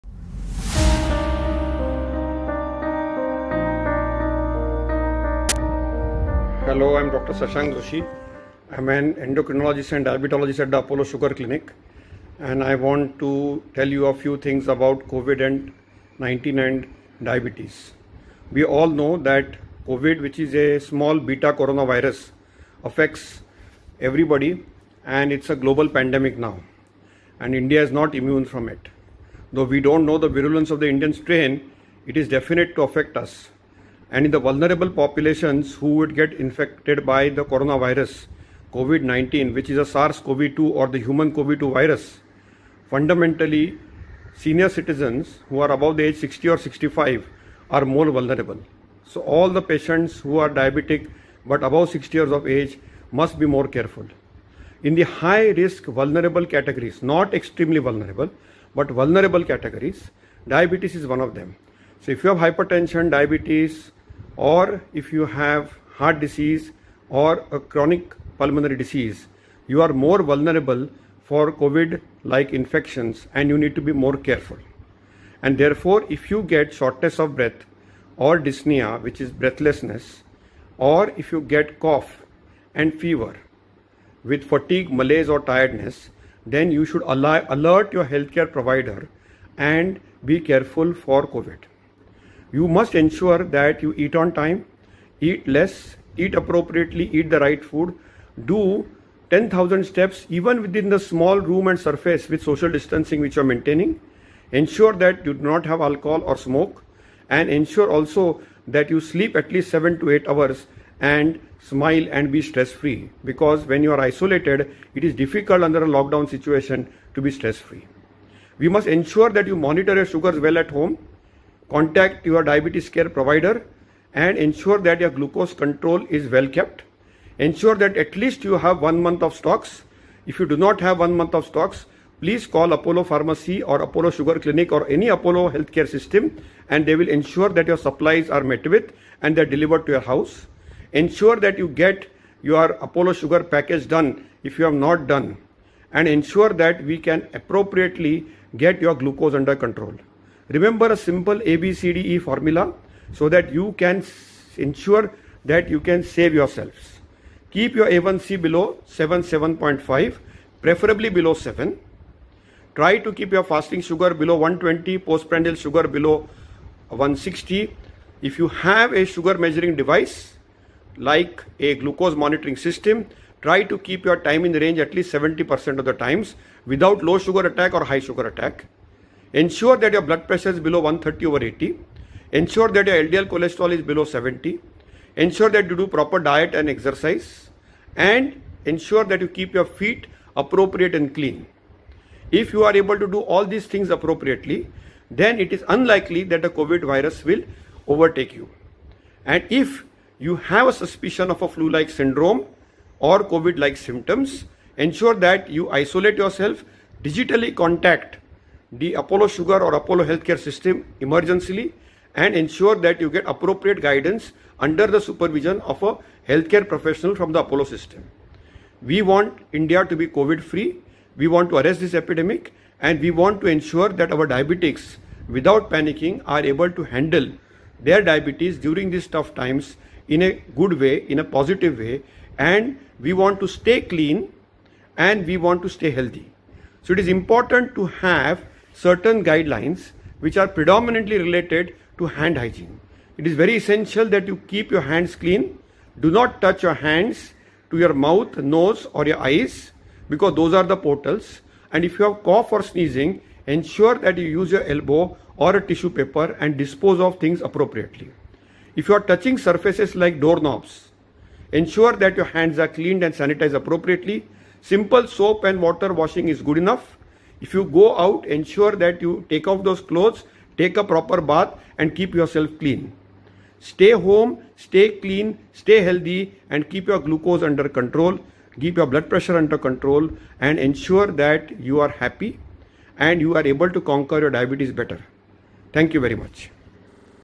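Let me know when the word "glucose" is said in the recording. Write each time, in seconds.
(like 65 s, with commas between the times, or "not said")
125 s, 149 s, 171 s, 277 s.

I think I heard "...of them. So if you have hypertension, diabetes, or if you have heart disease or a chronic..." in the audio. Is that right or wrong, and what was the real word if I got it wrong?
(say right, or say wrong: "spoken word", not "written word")
right.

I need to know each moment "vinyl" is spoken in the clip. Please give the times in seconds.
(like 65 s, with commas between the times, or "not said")
not said.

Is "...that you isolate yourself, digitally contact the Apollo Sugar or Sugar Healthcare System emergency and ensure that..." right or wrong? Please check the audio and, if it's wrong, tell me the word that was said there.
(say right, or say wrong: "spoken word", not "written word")
wrong: "Apollo", not "Sugar".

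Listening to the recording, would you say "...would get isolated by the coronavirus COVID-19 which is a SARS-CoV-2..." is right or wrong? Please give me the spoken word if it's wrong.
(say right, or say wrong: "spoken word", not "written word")
wrong: "infected", not "isolated".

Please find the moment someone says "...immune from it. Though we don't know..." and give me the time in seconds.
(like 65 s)
28 s.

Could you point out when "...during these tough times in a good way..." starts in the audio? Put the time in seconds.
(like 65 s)
228 s.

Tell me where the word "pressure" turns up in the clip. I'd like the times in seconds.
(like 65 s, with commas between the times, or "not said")
180 s, 279 s.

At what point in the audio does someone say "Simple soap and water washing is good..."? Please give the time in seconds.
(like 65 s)
264 s.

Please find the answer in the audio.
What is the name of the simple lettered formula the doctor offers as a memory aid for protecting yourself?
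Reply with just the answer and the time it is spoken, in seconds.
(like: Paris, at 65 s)
ABCDE, at 151 s.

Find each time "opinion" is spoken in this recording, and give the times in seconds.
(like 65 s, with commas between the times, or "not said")
not said.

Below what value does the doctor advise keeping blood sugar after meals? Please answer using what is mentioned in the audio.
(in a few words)
160.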